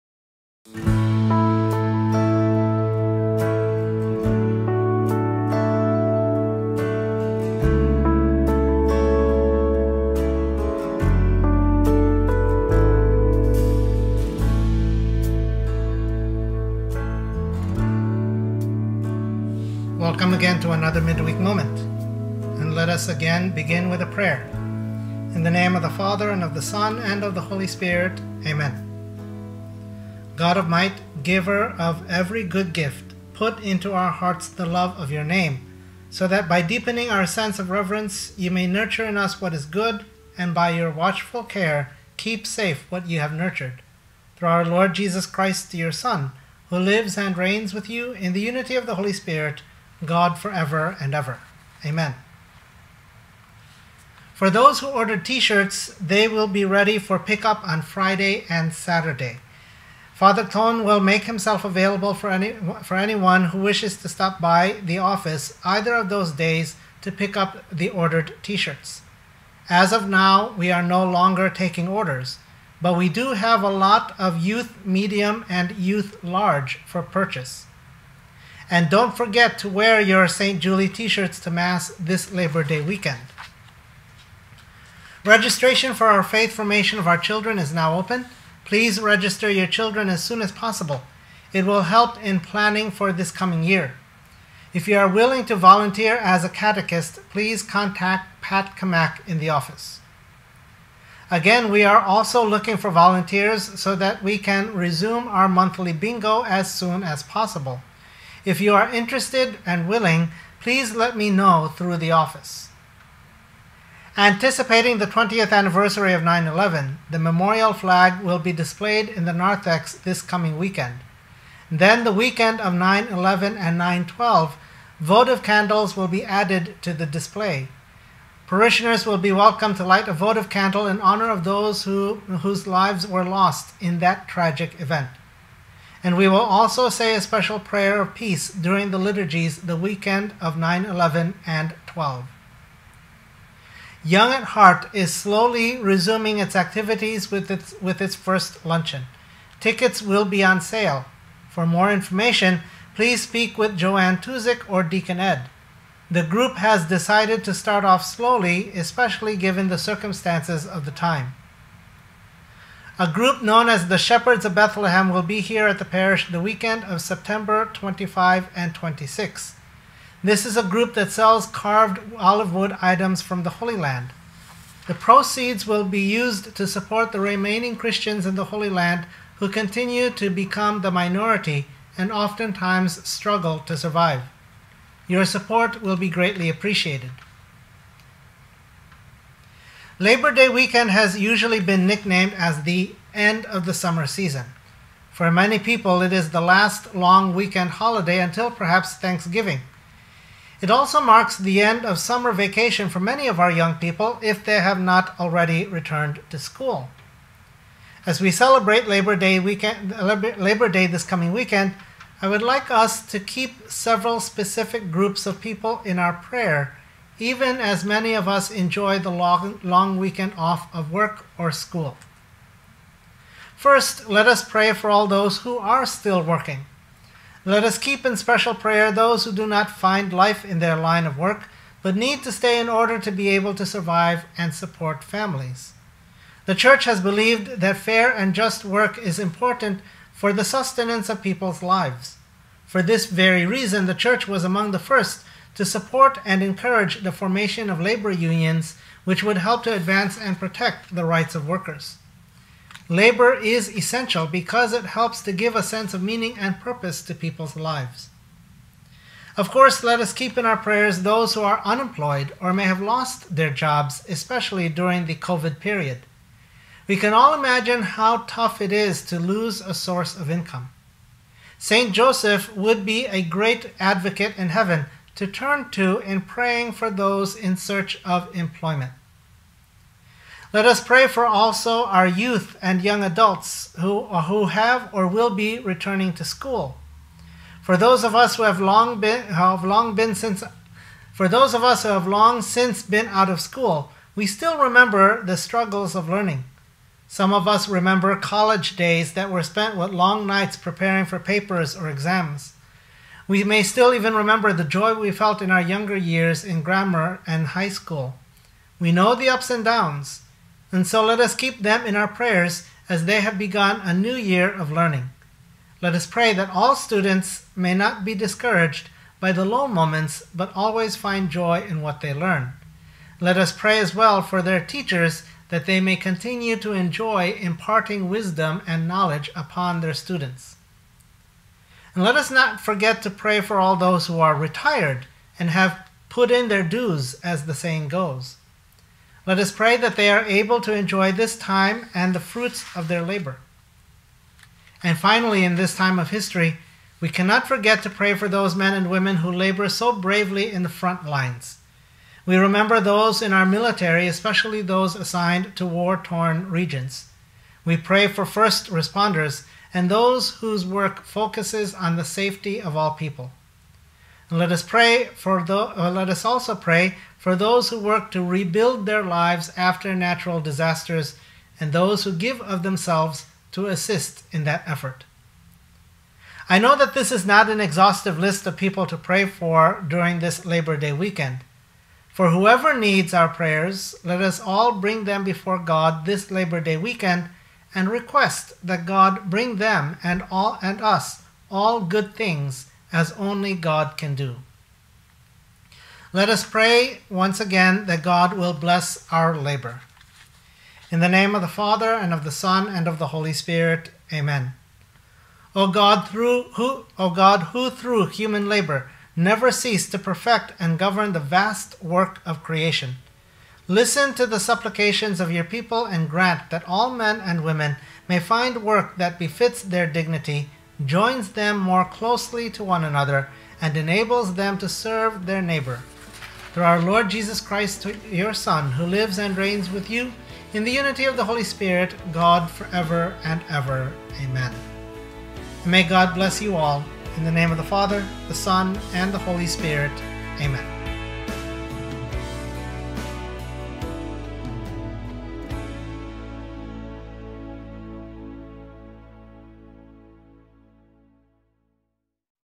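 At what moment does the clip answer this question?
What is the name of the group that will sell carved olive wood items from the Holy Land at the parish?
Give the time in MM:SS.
02:43.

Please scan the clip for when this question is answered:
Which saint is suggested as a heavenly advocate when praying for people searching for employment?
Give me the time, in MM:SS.
04:31.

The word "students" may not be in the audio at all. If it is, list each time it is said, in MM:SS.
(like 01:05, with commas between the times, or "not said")
05:16, 05:29.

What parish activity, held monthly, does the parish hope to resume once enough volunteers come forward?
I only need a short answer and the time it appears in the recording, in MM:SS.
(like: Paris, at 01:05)
bingo, at 01:45.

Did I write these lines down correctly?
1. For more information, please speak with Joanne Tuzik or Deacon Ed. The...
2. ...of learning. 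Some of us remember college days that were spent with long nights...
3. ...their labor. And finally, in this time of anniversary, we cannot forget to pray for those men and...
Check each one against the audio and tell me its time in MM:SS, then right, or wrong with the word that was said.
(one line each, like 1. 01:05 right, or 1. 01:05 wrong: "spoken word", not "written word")
1. 02:31 right
2. 04:55 right
3. 05:42 wrong: "history", not "anniversary".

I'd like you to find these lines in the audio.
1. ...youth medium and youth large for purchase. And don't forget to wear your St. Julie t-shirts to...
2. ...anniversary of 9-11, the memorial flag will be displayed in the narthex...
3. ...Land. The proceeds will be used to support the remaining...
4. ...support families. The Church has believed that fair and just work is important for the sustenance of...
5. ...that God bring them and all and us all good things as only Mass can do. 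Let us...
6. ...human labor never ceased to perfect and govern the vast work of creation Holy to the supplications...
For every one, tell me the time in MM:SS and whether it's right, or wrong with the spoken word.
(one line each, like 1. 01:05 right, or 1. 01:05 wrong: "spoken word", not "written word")
1. 01:14 right
2. 01:55 right
3. 02:53 right
4. 03:54 right
5. 06:28 wrong: "God", not "Mass"
6. 06:48 wrong: "Listen", not "Holy".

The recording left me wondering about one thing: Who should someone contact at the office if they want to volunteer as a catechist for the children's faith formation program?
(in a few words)
Pat Kamak.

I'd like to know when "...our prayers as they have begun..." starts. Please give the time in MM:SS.
05:11.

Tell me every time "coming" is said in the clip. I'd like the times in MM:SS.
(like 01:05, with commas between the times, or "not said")
01:33, 02:00, 03:31.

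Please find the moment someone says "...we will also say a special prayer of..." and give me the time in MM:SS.
02:16.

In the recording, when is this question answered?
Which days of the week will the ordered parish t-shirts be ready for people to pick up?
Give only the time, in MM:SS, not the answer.
00:57.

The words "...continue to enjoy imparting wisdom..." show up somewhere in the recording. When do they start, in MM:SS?
05:25.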